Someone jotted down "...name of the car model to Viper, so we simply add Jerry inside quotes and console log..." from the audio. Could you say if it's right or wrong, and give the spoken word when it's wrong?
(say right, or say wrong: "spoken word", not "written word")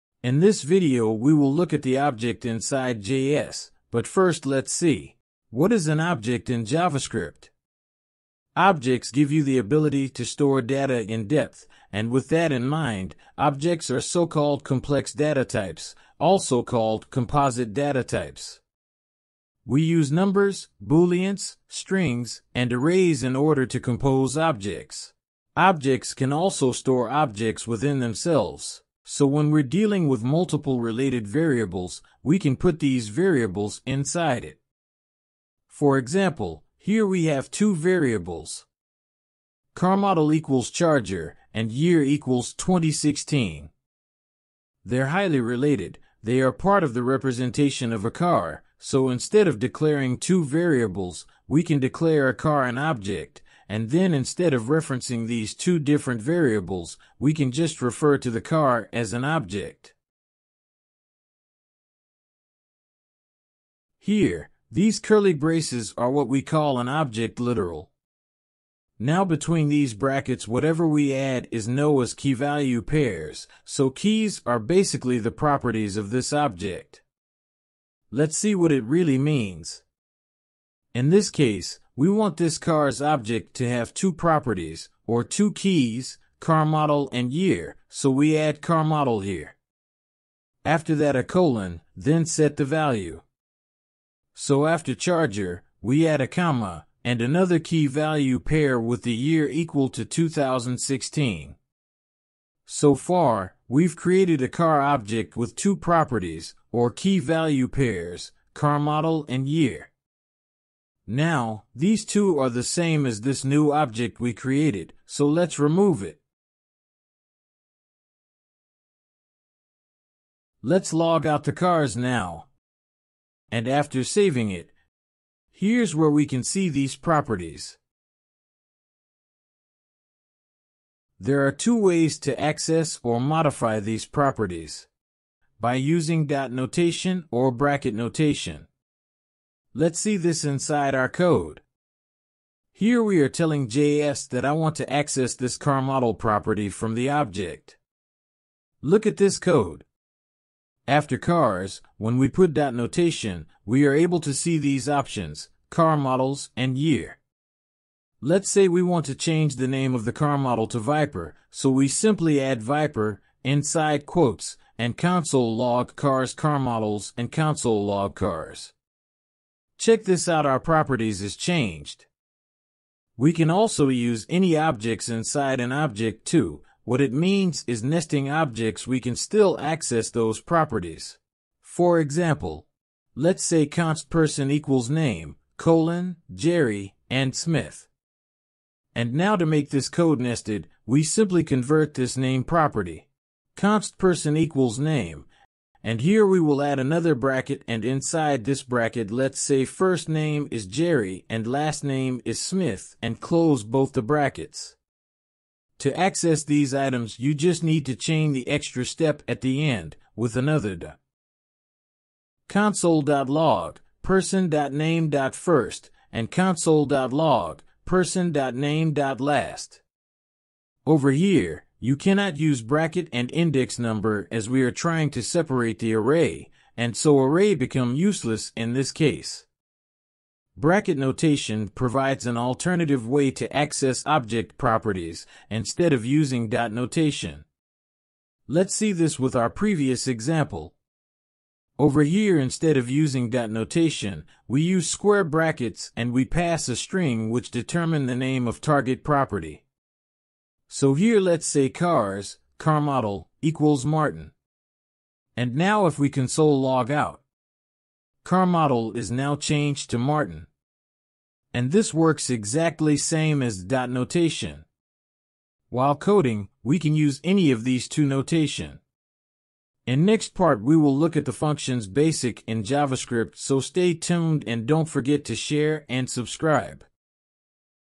wrong: "Viper", not "Jerry".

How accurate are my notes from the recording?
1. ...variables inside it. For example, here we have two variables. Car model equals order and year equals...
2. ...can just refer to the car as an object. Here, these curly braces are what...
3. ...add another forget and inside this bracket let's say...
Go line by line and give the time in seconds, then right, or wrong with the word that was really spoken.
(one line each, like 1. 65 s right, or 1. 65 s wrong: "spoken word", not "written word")
1. 33 s wrong: "charger", not "order"
2. 57 s right
3. 196 s wrong: "bracket", not "forget".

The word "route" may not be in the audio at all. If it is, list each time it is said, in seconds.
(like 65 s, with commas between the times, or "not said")
not said.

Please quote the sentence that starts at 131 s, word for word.
There are two ways to access or modify these properties.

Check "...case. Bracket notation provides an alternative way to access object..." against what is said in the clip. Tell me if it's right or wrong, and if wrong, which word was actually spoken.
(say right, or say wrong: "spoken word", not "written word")
right.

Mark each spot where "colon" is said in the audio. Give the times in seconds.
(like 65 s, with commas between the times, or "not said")
91 s, 185 s.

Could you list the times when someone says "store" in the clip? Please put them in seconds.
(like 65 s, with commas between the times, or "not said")
10 s, 26 s.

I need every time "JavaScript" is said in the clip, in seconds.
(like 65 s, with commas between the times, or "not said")
6 s, 272 s.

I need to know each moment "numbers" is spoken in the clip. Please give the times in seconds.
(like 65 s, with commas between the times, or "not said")
20 s, 223 s.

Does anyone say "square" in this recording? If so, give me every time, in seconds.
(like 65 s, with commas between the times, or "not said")
244 s.